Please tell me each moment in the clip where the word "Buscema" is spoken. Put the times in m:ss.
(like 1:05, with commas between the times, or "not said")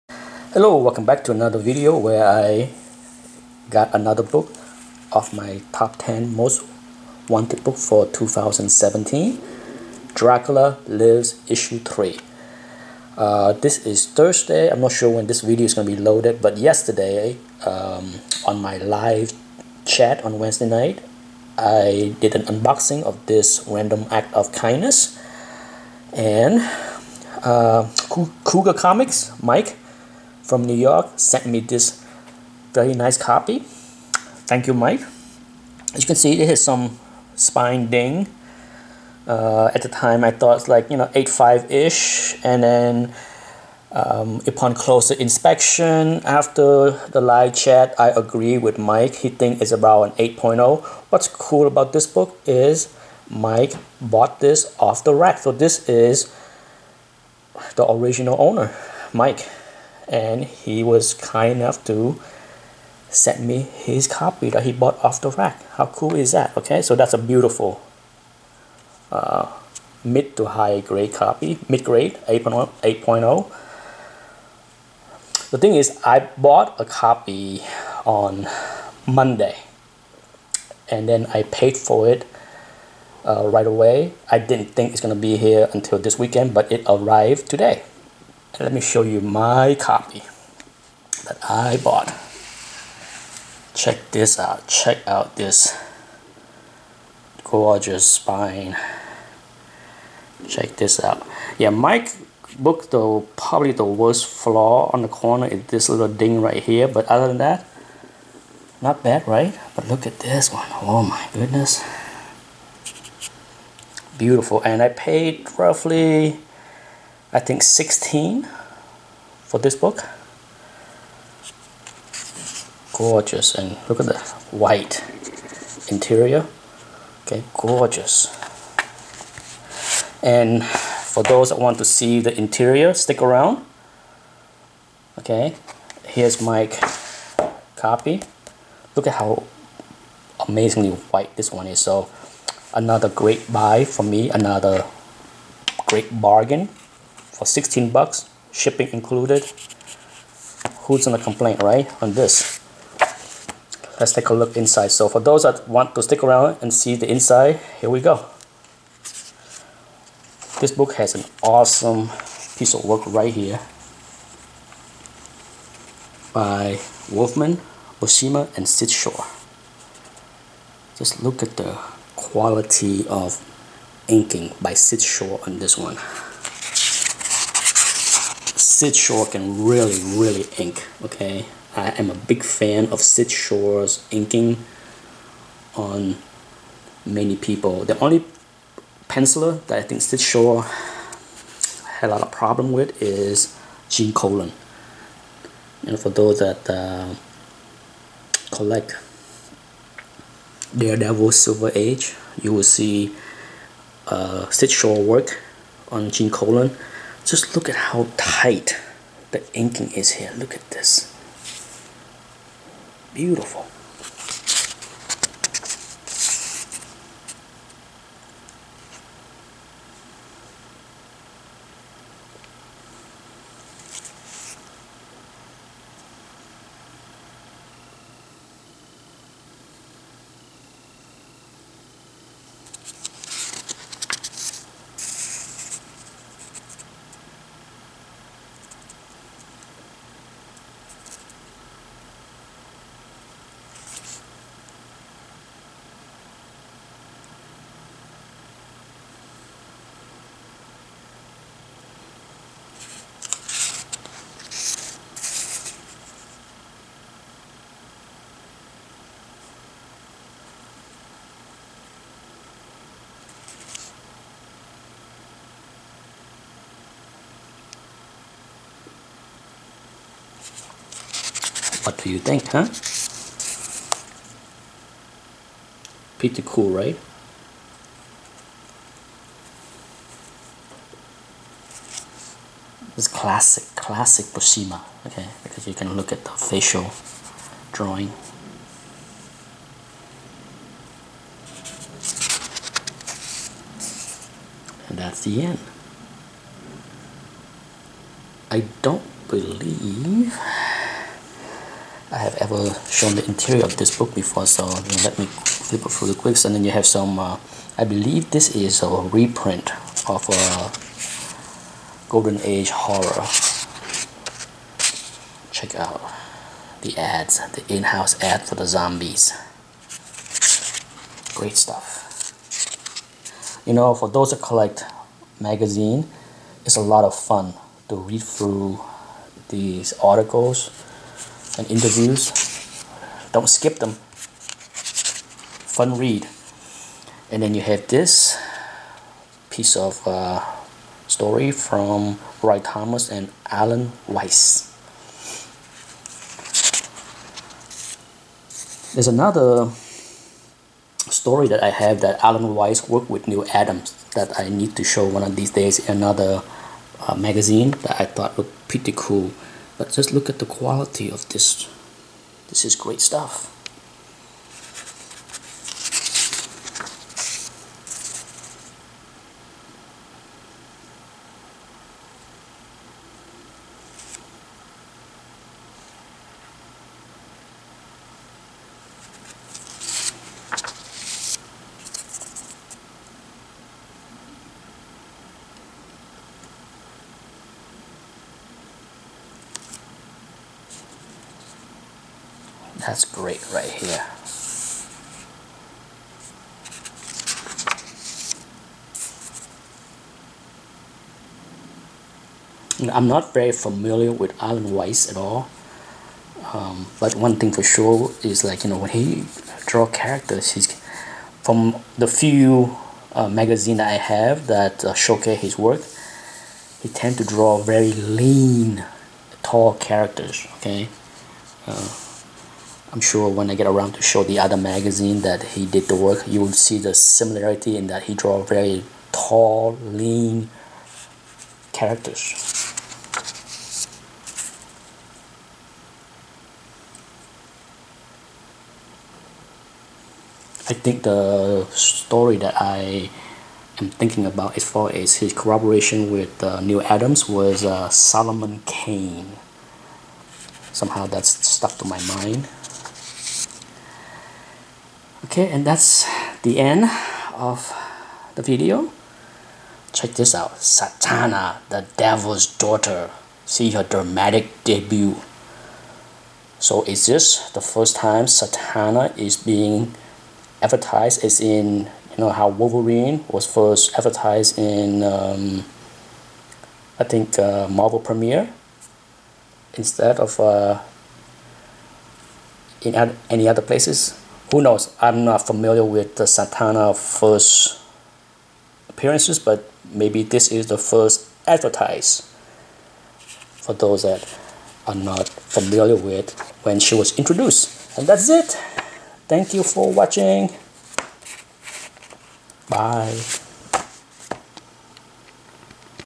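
2:47, 4:44.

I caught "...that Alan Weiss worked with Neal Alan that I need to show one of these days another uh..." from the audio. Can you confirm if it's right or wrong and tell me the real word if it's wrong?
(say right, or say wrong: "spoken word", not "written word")
wrong: "Adams", not "Alan".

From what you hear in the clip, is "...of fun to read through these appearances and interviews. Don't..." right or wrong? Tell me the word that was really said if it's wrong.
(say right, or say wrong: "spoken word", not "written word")
wrong: "articles", not "appearances".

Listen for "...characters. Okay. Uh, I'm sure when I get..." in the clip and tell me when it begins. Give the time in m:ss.
6:59.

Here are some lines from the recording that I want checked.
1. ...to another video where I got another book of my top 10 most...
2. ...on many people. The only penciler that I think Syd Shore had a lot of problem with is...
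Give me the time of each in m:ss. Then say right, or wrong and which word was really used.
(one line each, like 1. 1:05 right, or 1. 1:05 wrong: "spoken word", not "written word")
1. 0:01 right
2. 3:05 right.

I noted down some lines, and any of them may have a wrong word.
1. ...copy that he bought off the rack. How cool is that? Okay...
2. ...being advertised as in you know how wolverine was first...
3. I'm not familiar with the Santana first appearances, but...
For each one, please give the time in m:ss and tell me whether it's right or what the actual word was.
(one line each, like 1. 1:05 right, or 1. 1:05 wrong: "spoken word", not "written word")
1. 1:04 right
2. 7:49 right
3. 8:05 right.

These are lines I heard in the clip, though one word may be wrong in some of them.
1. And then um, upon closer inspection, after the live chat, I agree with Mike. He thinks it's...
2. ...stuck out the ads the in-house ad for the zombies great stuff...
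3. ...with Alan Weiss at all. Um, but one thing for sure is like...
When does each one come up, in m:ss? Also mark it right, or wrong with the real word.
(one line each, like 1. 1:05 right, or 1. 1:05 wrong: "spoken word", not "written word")
1. 0:42 right
2. 5:15 wrong: "check", not "stuck"
3. 6:44 right.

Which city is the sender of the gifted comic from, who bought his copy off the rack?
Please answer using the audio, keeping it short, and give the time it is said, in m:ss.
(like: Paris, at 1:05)
New York, at 0:30.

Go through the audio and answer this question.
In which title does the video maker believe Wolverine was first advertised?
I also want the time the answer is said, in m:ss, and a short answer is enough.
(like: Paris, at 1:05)
Marvel Premiere, at 7:57.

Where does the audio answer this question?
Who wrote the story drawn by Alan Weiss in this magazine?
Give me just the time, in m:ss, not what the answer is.
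5:42.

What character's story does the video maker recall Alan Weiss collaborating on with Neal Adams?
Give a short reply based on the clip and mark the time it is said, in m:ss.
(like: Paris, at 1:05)
Solomon Kane, at 7:27.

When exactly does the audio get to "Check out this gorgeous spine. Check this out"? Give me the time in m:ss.
1:34.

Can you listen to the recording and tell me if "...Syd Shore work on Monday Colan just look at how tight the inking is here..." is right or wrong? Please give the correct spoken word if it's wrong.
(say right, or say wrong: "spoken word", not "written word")
wrong: "Gene", not "Monday".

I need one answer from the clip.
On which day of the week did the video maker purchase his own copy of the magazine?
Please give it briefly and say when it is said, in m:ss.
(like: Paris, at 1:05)
Monday, at 1:19.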